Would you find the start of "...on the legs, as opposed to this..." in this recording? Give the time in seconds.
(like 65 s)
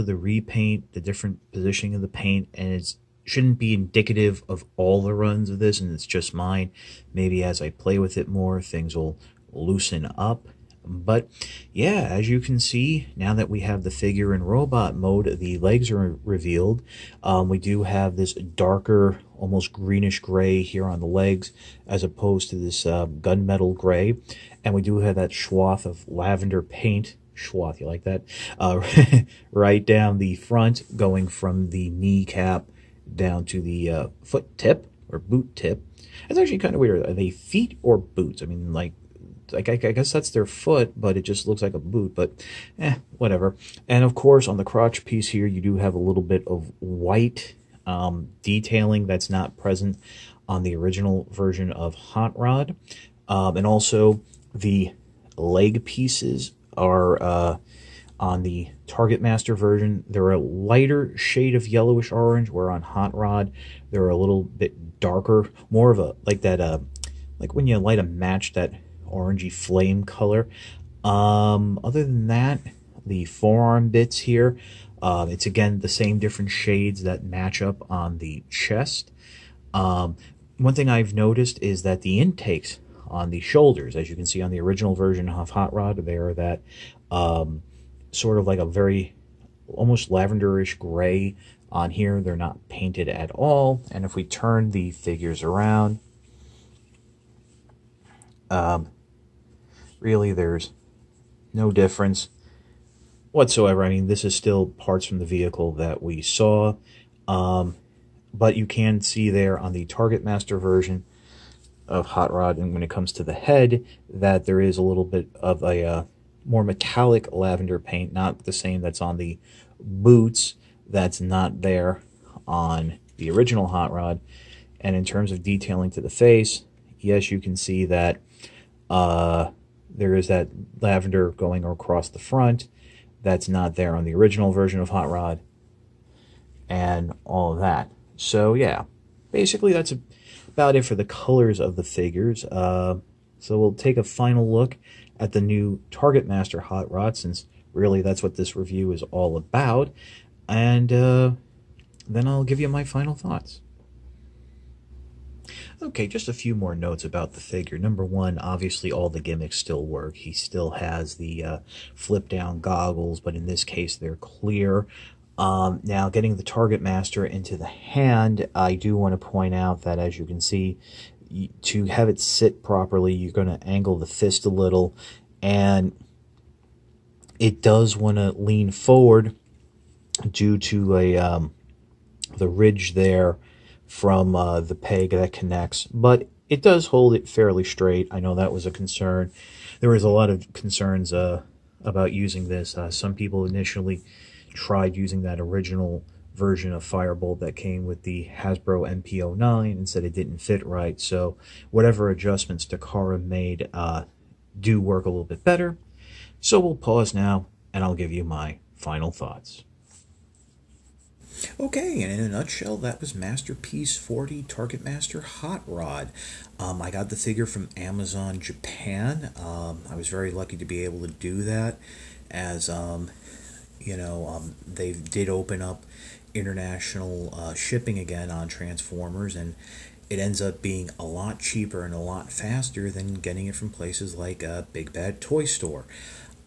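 20 s.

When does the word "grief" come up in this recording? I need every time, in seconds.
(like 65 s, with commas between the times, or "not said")
not said.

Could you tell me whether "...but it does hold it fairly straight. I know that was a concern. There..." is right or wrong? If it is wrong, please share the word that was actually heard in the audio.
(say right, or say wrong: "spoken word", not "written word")
right.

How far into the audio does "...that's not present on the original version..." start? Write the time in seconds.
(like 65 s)
49 s.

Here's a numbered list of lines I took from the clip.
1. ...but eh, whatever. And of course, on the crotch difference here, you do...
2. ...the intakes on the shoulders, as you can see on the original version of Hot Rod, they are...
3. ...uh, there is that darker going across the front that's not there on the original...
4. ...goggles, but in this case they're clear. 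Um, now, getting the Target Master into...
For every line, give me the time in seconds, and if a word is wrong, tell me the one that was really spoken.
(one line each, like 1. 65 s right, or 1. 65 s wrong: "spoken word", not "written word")
1. 42 s wrong: "piece", not "difference"
2. 82 s right
3. 128 s wrong: "lavender", not "darker"
4. 162 s right.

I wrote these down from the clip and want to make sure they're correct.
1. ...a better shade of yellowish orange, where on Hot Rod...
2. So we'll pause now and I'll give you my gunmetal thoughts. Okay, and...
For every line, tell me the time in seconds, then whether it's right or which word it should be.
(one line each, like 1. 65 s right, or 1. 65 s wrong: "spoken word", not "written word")
1. 60 s wrong: "lighter", not "better"
2. 206 s wrong: "final", not "gunmetal".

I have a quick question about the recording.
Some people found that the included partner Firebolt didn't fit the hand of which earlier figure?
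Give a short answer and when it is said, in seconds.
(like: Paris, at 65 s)
Hasbro MP09, at 198 s.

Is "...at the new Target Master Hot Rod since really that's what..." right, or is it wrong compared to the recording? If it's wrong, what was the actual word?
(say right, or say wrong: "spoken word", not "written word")
right.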